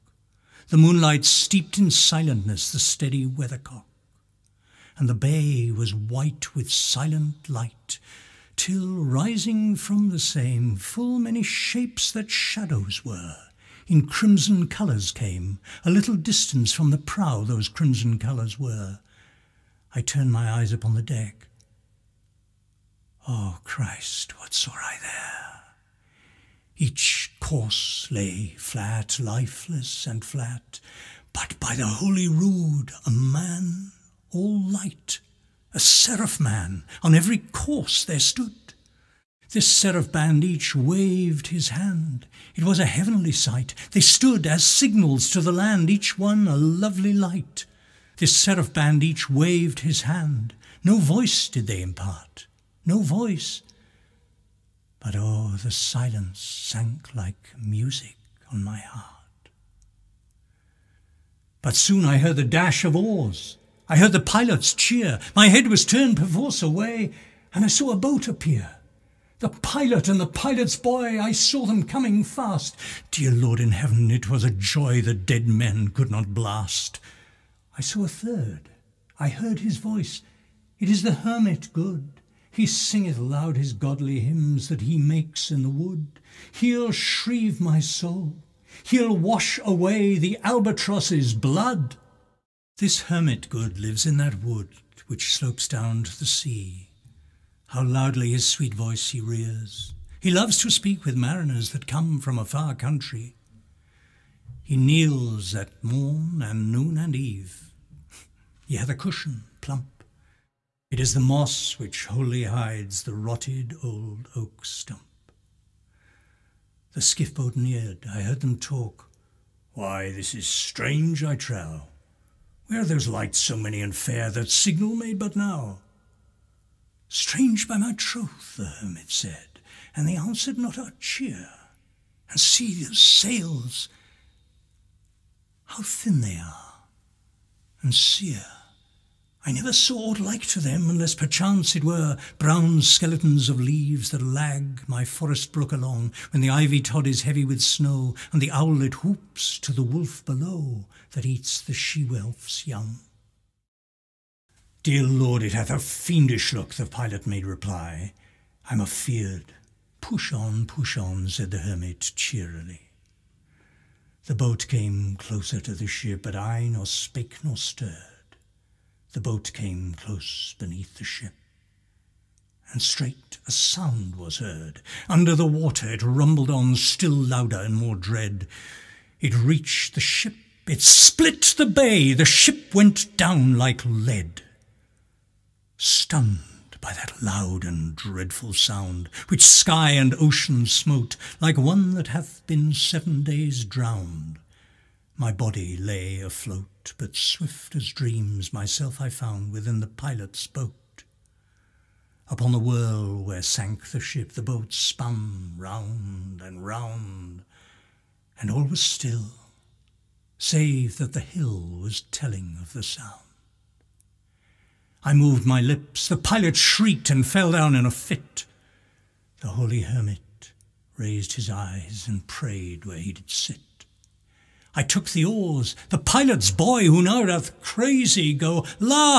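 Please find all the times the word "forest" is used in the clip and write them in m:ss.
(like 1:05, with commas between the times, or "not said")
2:25.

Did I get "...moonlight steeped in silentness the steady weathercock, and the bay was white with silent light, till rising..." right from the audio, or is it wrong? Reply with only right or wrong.
right.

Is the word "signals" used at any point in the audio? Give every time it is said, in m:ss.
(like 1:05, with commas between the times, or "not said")
0:44, 2:04.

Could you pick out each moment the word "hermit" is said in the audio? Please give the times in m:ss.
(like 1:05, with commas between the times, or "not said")
1:21, 1:33, 2:08, 2:41, 3:39.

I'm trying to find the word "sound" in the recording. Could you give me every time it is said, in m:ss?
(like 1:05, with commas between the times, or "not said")
2:53, 3:08, 3:32.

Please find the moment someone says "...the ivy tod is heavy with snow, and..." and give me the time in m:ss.
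2:26.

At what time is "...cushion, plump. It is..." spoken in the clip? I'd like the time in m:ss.
1:48.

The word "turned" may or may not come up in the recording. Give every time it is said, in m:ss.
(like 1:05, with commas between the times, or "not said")
0:20, 1:05.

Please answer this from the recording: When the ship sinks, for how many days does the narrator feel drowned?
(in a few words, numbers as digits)
7.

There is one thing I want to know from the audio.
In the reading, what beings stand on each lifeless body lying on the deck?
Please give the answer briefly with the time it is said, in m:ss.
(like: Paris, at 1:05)
Seraph man, at 0:35.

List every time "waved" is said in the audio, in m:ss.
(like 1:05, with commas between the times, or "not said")
0:40, 0:49.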